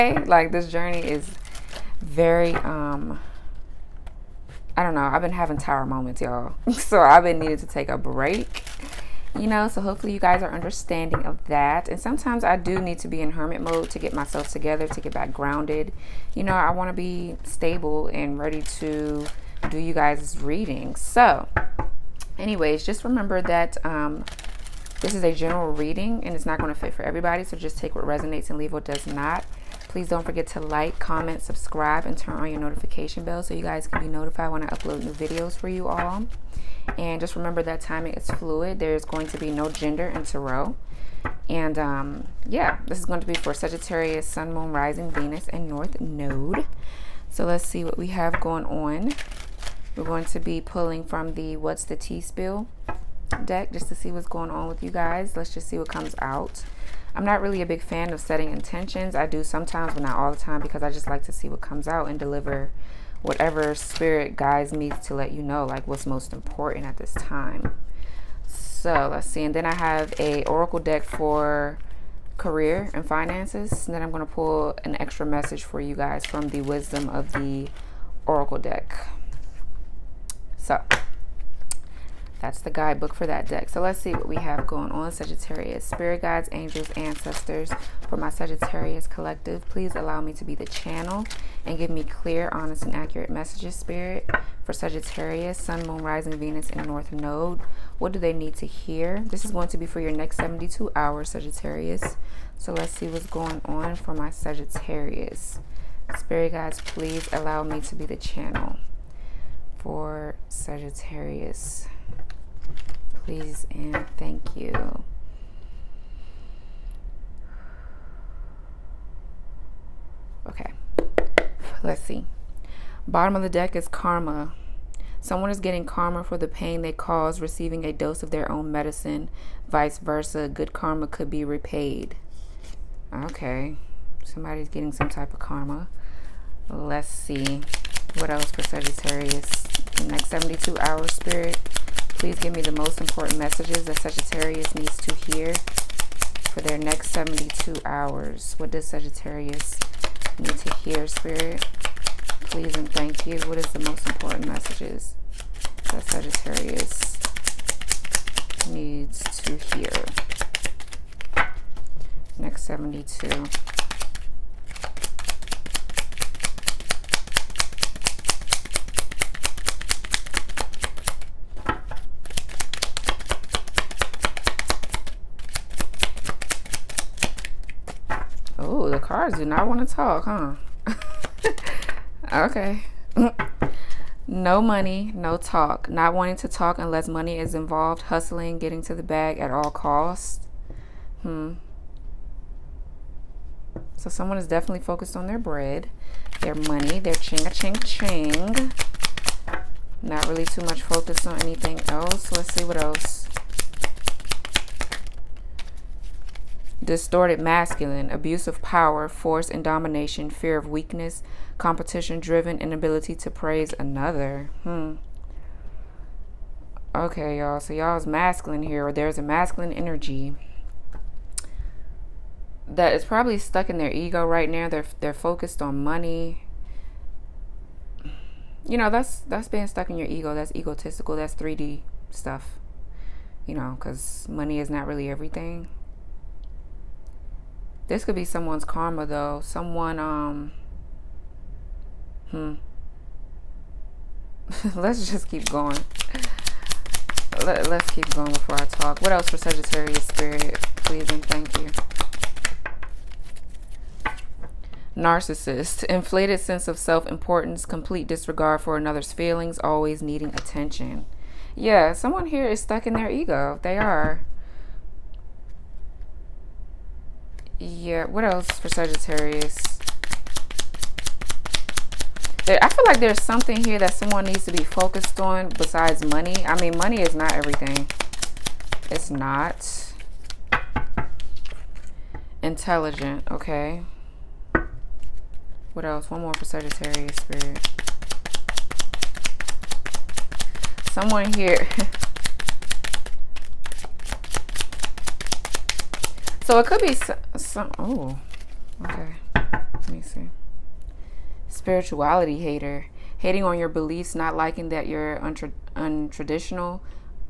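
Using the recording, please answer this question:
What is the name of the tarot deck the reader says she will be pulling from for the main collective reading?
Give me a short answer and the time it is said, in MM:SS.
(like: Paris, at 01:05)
What's the Tea Spill, at 00:51.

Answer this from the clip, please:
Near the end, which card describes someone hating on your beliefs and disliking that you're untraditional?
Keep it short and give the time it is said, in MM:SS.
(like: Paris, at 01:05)
Spirituality hater, at 05:01.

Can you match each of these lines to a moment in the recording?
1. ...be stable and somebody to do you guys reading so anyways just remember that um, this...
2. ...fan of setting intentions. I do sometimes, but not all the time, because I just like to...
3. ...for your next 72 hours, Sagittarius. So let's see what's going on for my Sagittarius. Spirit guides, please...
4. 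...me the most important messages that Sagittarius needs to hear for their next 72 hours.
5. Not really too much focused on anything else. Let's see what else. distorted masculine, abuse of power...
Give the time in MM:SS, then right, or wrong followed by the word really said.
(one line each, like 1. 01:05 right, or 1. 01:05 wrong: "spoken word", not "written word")
1. 00:16 wrong: "ready", not "somebody"
2. 00:57 right
3. 01:39 right
4. 02:22 right
5. 03:20 right.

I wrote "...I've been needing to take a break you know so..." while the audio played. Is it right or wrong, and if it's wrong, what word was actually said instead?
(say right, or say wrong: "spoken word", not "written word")
right.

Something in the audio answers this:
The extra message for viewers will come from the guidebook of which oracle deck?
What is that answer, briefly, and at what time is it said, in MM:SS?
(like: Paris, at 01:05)
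Wisdom of the Oracle, at 01:16.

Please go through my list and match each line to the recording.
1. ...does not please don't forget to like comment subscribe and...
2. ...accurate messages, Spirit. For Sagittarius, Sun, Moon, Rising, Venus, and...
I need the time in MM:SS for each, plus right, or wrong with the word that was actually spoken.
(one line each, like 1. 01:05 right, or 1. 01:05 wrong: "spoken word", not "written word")
1. 00:28 right
2. 01:32 right.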